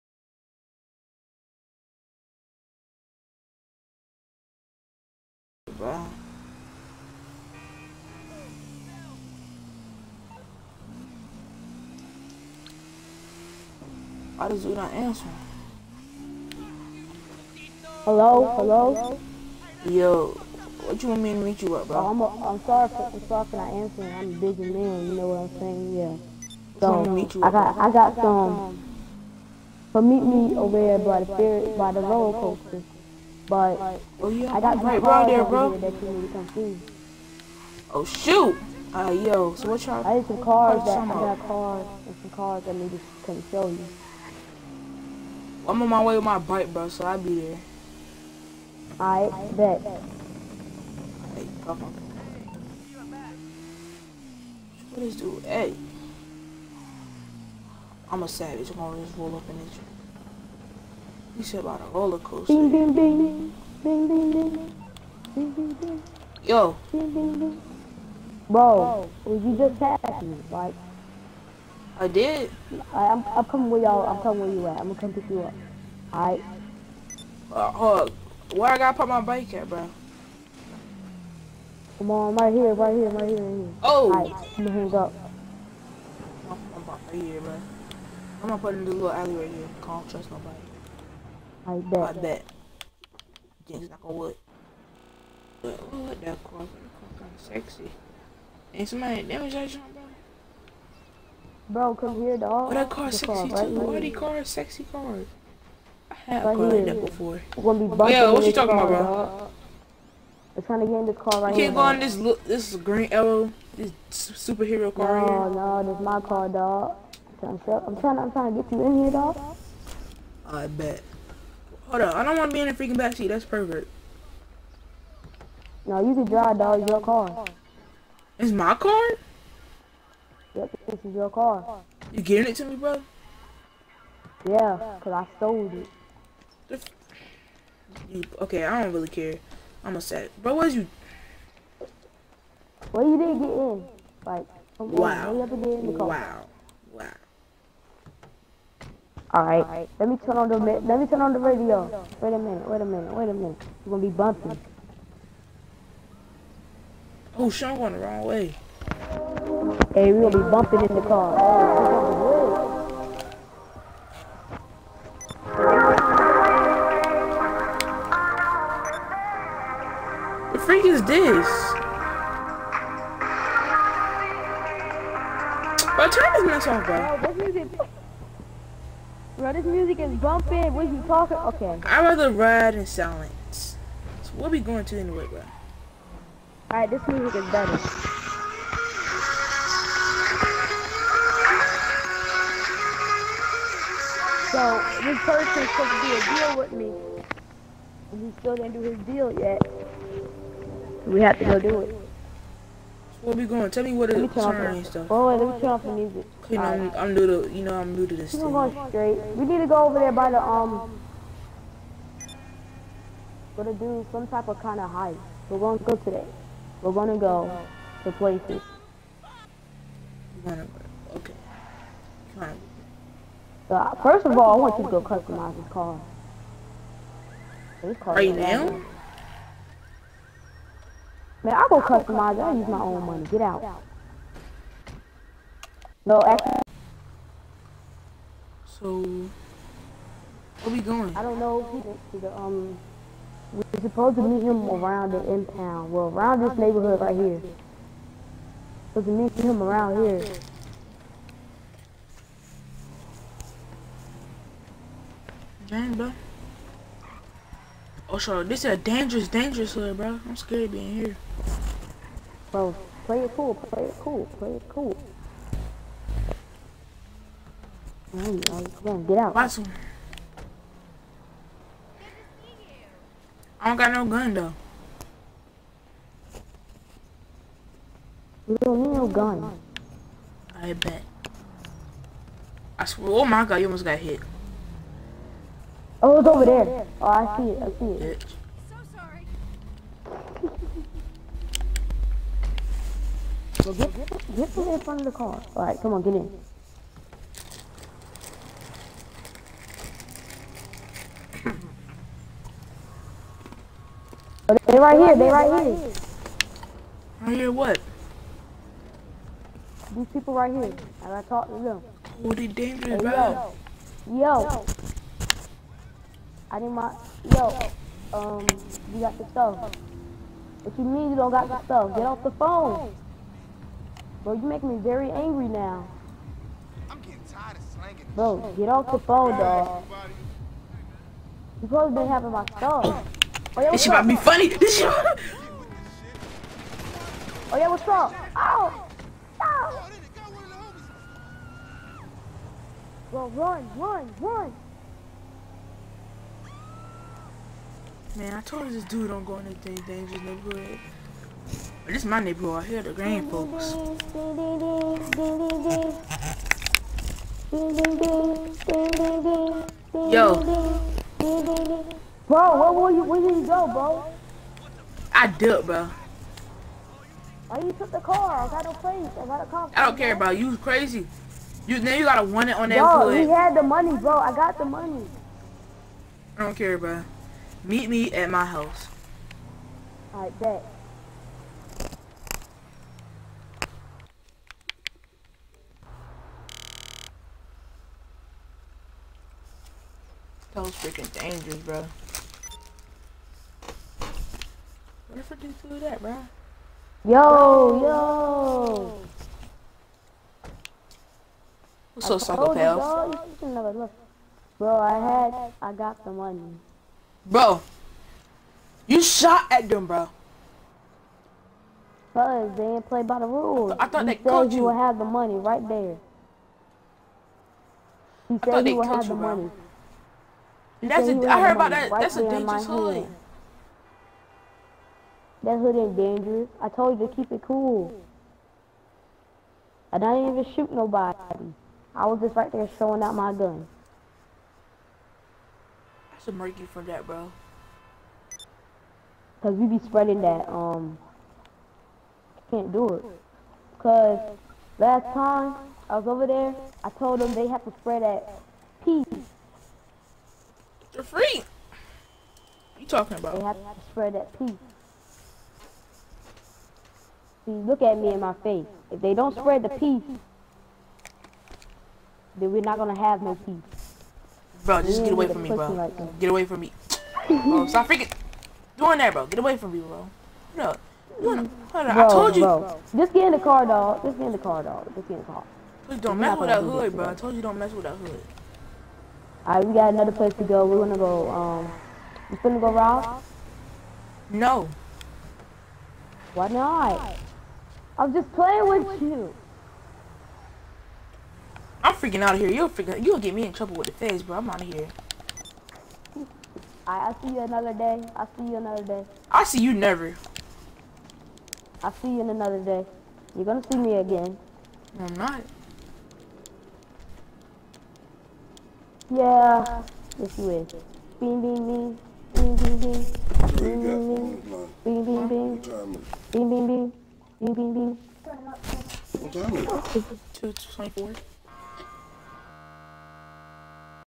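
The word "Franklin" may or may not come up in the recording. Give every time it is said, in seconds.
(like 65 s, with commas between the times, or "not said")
not said.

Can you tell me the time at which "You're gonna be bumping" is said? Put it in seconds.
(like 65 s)
153 s.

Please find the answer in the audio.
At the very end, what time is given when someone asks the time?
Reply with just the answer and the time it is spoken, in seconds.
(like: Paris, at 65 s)
2:24, at 520 s.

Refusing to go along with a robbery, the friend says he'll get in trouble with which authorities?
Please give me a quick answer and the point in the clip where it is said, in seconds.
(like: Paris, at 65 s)
The feds, at 493 s.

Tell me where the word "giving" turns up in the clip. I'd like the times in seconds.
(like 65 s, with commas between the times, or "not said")
132 s.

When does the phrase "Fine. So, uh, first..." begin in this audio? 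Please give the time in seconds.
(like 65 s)
222 s.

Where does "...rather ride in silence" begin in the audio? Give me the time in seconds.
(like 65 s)
182 s.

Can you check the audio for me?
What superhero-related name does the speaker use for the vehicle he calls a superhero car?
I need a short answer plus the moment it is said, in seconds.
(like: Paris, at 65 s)
Green Arrow, at 112 s.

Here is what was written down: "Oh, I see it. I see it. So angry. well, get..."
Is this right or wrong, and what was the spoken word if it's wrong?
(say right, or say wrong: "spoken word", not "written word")
wrong: "sorry", not "angry".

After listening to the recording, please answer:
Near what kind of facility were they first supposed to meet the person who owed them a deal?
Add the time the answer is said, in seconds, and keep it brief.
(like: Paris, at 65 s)
The impound, at 245 s.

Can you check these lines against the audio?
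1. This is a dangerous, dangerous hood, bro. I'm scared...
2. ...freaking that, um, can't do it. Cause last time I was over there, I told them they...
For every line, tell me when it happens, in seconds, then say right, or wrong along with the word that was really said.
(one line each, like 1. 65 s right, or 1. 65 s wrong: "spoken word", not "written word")
1. 258 s right
2. 439 s wrong: "spreading", not "freaking".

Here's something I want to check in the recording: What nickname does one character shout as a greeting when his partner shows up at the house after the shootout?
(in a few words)
Psycho.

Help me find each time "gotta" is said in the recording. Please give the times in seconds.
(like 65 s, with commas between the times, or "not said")
78 s, 311 s, 372 s.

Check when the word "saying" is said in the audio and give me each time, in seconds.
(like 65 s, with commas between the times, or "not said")
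25 s.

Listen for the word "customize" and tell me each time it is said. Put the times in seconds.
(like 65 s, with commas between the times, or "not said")
225 s, 231 s.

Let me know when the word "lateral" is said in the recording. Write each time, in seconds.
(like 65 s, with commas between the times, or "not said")
not said.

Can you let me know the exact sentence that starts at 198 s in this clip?
And he still didn't do his deal yet.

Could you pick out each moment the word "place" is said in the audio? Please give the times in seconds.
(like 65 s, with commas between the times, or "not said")
218 s, 368 s, 480 s.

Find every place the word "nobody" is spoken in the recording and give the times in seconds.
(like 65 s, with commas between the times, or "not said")
90 s, 430 s.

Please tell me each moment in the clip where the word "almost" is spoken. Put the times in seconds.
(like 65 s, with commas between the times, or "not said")
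283 s.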